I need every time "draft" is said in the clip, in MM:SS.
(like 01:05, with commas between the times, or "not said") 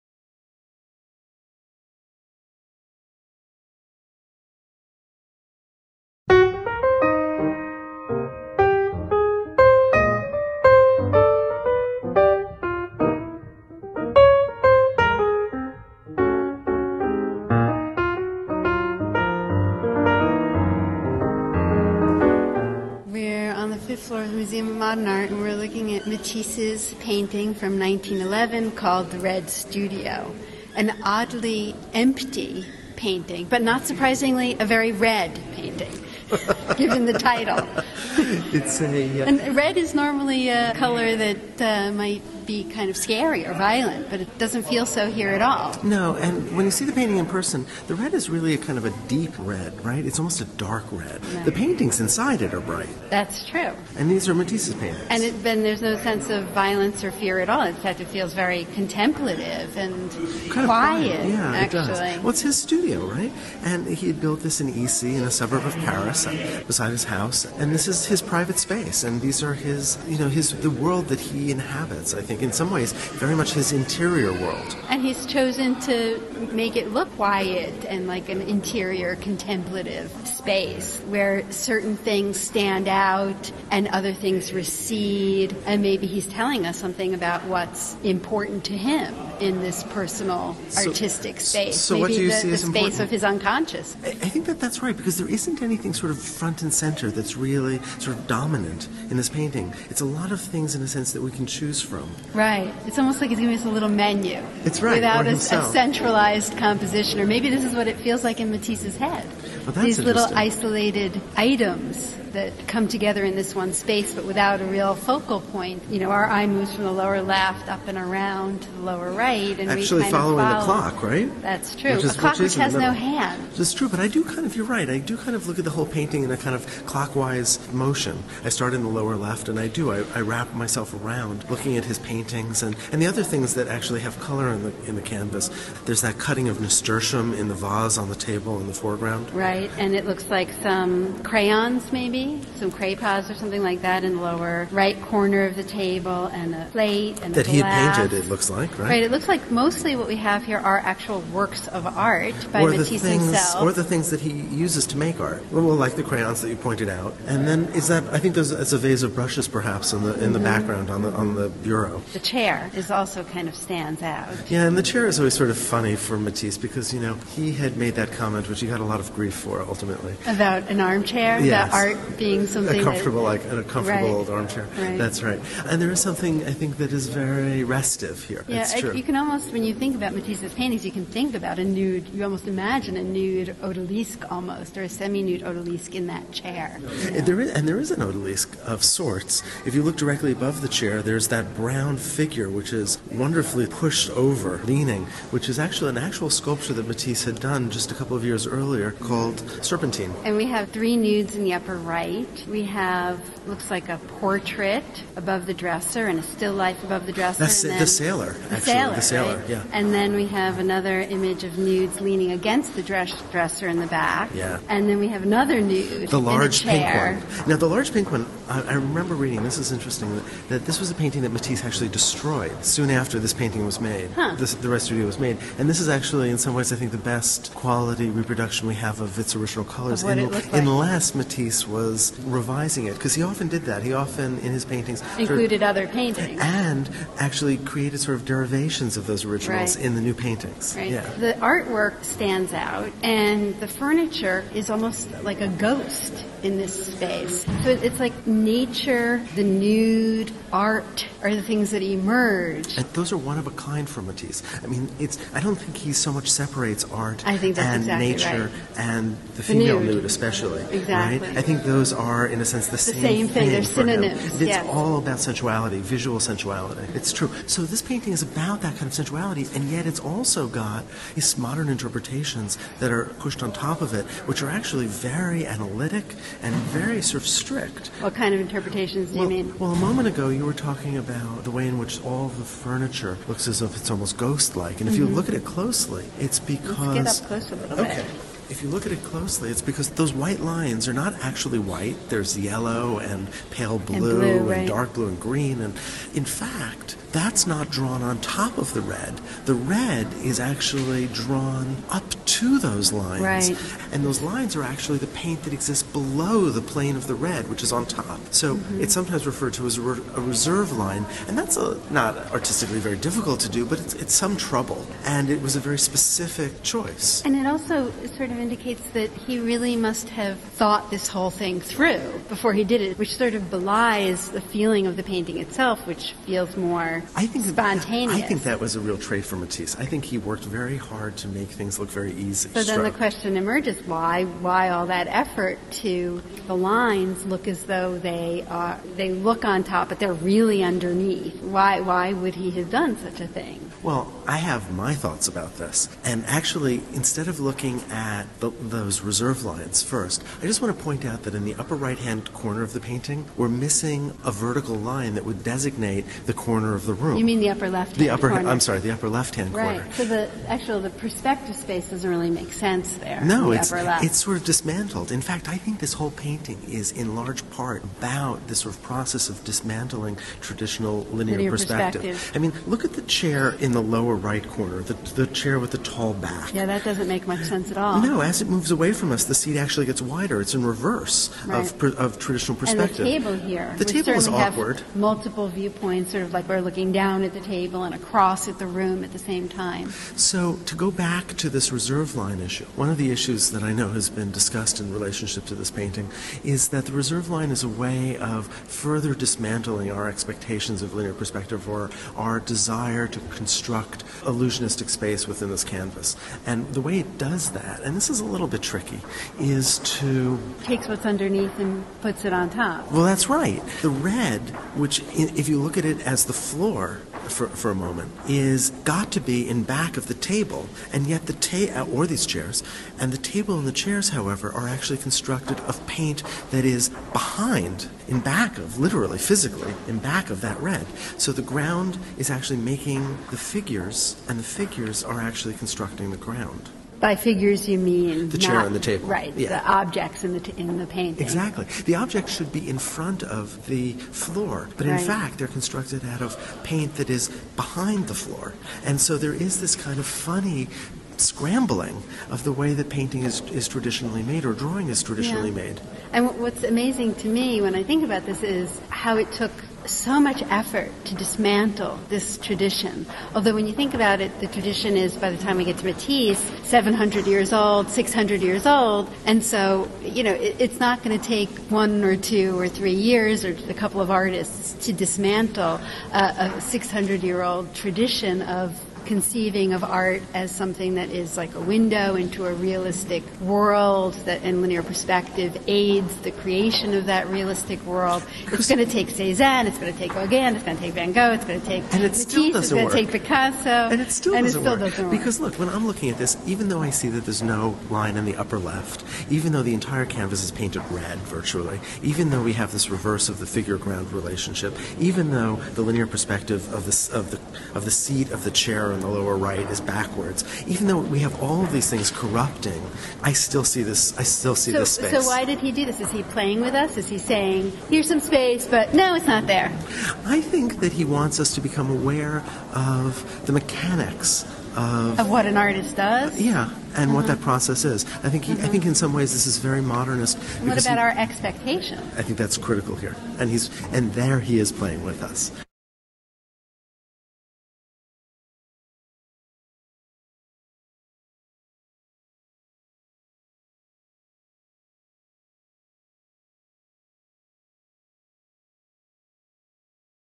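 not said.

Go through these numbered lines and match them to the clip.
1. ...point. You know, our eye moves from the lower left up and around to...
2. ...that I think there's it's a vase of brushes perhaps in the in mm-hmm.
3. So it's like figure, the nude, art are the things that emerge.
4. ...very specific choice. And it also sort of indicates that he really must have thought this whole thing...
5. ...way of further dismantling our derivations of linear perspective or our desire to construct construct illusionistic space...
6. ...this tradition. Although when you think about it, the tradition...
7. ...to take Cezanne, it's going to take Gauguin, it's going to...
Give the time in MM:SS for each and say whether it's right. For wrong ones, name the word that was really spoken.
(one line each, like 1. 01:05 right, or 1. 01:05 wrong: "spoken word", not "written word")
1. 01:55 right
2. 02:37 right
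3. 04:07 wrong: "nature", not "figure"
4. 05:15 right
5. 06:37 wrong: "expectations", not "derivations"
6. 07:42 right
7. 08:08 right.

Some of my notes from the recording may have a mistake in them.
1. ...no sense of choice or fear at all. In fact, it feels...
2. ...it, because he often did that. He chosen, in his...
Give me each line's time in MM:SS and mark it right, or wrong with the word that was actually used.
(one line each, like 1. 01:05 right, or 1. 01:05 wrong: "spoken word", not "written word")
1. 00:55 wrong: "violence", not "choice"
2. 03:52 wrong: "often", not "chosen".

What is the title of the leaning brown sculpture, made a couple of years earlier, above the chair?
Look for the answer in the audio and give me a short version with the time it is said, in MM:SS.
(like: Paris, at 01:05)
Serpentine, at 03:19.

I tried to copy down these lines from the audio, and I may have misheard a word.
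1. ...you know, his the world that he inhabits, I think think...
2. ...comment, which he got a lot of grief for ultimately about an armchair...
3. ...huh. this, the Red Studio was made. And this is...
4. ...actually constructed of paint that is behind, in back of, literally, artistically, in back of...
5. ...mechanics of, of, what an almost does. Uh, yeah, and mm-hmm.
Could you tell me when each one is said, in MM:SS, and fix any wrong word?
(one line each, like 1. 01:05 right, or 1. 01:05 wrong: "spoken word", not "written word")
1. 01:10 right
2. 02:48 right
3. 03:44 right
4. 07:04 wrong: "physically", not "artistically"
5. 08:43 wrong: "artist", not "almost".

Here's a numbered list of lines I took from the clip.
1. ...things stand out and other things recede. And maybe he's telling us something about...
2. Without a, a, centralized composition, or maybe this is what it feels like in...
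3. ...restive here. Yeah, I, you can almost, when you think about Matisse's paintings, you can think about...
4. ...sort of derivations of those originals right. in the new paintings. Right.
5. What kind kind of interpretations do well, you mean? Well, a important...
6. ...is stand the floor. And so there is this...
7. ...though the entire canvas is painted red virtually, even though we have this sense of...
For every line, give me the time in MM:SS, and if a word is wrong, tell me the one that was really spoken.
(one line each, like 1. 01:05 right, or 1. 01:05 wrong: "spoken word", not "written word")
1. 01:21 right
2. 01:44 right
3. 02:57 right
4. 03:57 right
5. 04:38 wrong: "moment", not "important"
6. 07:27 wrong: "behind", not "stand"
7. 08:19 wrong: "reverse", not "sense".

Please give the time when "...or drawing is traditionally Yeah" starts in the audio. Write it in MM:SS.
07:34.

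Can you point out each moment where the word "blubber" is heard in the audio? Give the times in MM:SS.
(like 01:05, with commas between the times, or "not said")
not said.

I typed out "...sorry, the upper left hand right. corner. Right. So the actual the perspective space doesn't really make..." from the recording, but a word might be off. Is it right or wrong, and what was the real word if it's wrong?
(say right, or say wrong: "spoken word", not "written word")
right.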